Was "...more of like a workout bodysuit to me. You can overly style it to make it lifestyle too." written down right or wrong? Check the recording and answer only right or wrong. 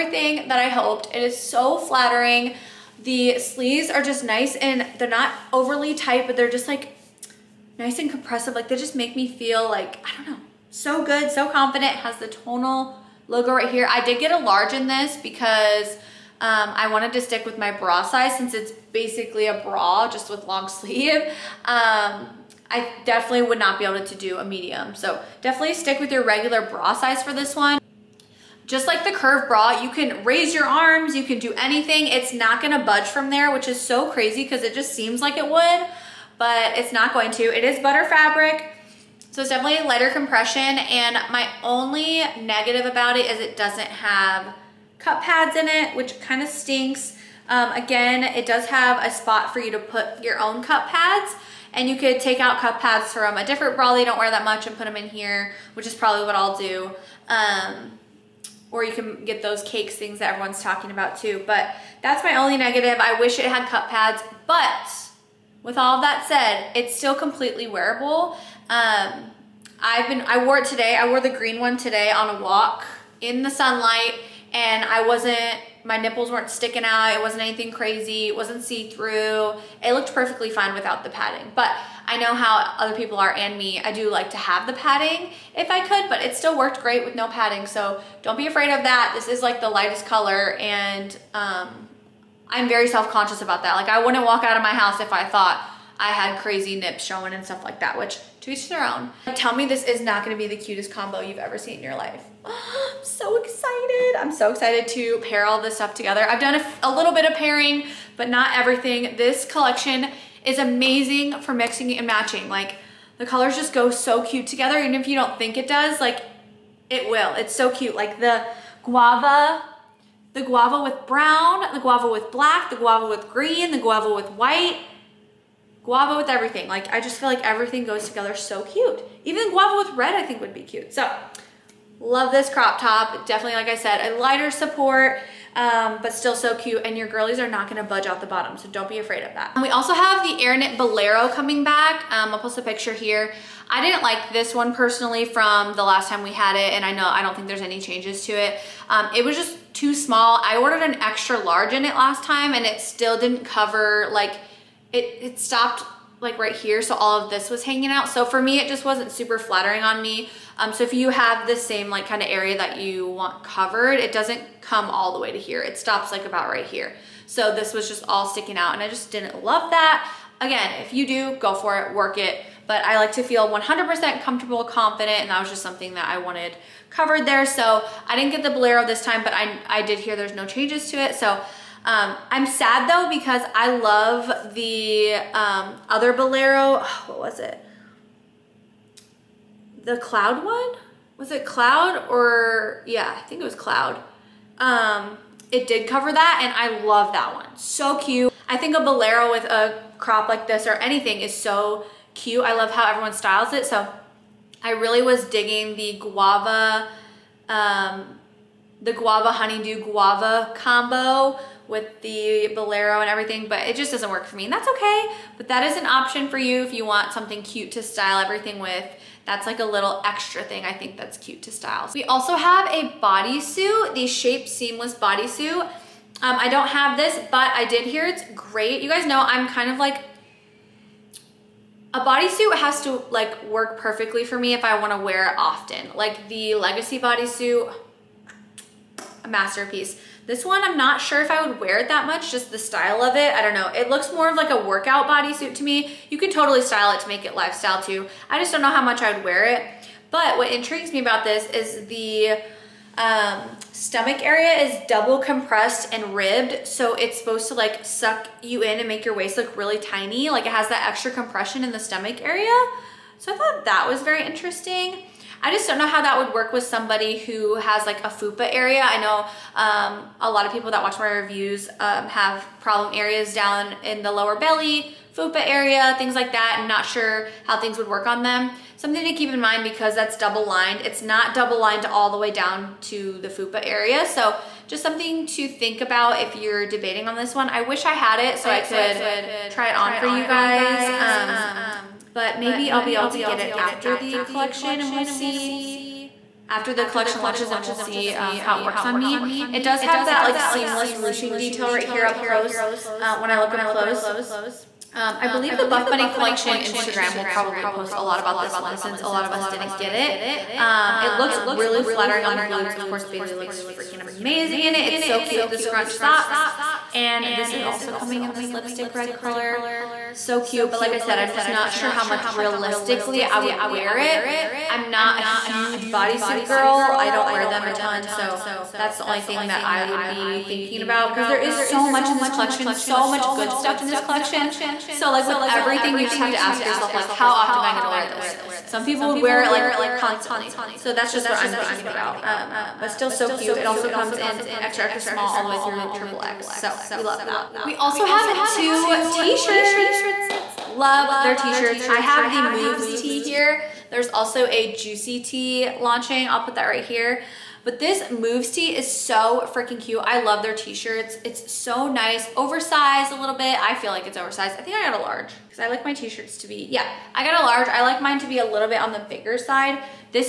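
wrong.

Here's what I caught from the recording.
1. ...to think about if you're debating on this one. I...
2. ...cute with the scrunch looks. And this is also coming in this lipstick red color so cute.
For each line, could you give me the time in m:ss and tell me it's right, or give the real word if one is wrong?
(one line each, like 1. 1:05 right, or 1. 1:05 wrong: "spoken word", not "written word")
1. 4:45 right
2. 5:15 wrong: "socks", not "looks".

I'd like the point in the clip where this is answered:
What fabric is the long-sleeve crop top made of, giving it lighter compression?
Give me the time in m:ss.
0:37.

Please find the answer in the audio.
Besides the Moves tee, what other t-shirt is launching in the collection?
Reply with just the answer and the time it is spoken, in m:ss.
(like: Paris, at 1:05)
Juicy tee, at 5:54.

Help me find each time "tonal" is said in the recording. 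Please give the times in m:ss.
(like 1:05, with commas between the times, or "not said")
0:12.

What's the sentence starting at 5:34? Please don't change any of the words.
So like with everything, you just have to ask yourself like, how often am I gonna wear this?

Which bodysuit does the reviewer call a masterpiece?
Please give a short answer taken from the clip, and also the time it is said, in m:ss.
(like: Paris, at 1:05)
Legacy bodysuit, at 3:56.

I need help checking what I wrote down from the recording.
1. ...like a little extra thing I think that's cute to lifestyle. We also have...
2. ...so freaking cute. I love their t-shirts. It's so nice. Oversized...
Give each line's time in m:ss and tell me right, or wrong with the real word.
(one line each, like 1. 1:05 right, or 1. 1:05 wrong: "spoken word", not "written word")
1. 3:39 wrong: "style", not "lifestyle"
2. 5:58 right.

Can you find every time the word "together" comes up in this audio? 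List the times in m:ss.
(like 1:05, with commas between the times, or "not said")
1:45, 1:54, 2:08.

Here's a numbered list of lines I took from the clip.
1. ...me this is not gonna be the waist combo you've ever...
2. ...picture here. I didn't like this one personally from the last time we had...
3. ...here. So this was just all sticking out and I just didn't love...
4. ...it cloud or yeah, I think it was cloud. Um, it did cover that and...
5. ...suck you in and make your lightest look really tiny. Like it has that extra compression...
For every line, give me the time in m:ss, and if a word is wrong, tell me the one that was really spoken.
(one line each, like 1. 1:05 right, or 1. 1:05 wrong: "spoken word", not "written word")
1. 1:39 wrong: "cutest", not "waist"
2. 2:22 right
3. 2:46 right
4. 3:11 right
5. 4:17 wrong: "waist", not "lightest".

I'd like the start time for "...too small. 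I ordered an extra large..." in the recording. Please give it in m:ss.
2:29.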